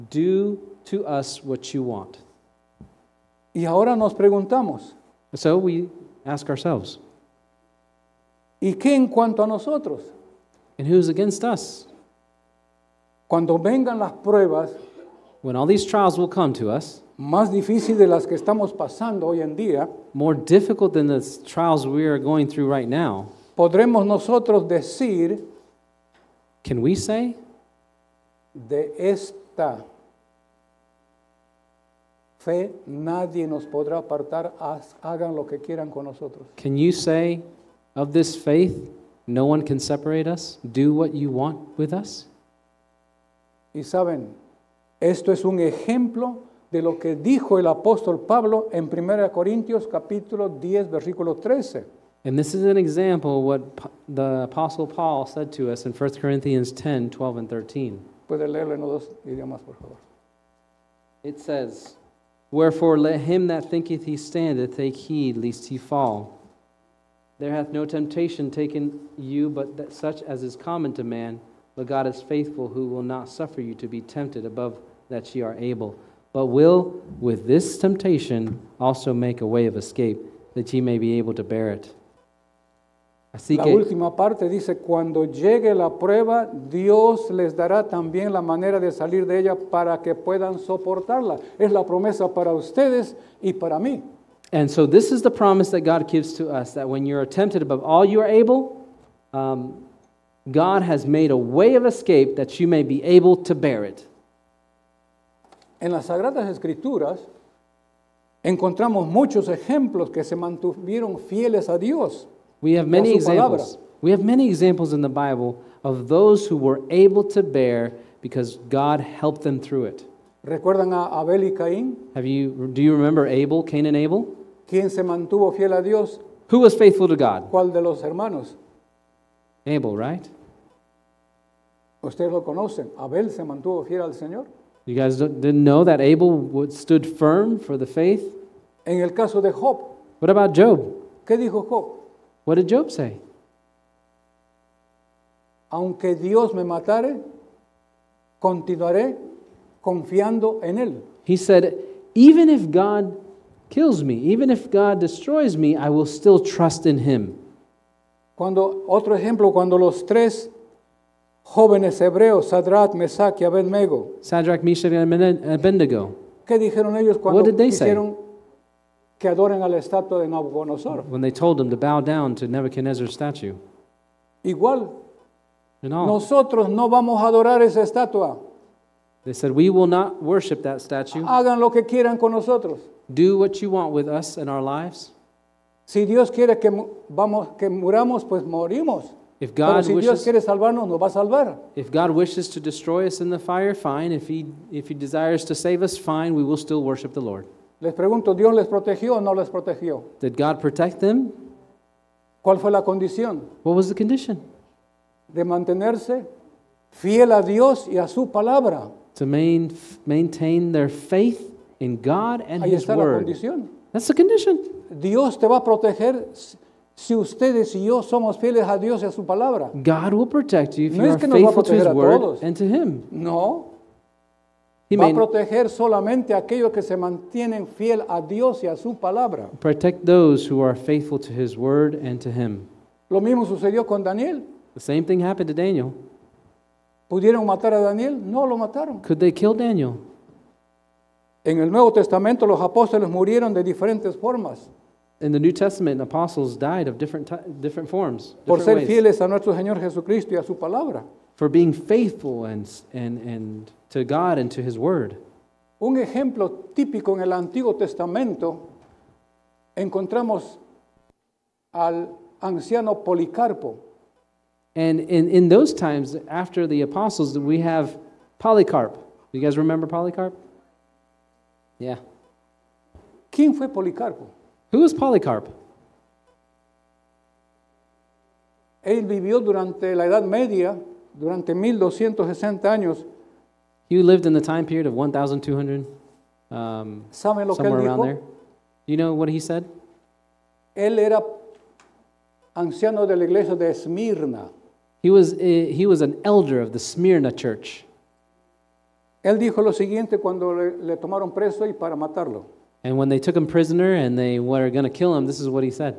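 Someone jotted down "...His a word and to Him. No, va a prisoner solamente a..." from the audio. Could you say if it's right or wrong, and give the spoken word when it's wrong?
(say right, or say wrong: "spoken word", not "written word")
wrong: "proteger", not "prisoner".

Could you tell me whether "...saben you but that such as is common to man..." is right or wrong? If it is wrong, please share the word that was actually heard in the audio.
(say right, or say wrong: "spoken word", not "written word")
wrong: "taken", not "saben".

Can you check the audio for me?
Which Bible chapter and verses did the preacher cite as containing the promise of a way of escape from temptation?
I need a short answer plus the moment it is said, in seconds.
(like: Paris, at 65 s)
1 Corinthians 10:12-13, at 55 s.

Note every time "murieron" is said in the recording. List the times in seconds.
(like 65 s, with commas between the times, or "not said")
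243 s.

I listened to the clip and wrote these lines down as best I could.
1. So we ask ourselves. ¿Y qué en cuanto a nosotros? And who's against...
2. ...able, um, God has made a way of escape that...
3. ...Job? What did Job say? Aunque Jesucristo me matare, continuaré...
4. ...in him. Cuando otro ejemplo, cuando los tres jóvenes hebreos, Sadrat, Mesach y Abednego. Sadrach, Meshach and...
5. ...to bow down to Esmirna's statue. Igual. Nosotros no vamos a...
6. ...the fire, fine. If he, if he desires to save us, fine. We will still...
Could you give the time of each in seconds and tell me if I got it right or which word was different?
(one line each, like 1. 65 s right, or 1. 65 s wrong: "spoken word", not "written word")
1. 5 s right
2. 98 s right
3. 141 s wrong: "Dios", not "Jesucristo"
4. 156 s right
5. 171 s wrong: "Nebuchadnezzar", not "Esmirna"
6. 193 s right.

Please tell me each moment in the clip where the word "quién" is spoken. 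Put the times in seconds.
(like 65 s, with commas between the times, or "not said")
124 s, 273 s.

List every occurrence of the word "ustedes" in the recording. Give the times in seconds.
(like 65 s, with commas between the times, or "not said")
92 s, 132 s, 217 s.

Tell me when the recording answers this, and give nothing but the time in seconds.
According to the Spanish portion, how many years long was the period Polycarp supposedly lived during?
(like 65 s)
281 s.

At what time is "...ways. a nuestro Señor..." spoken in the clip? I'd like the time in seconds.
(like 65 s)
248 s.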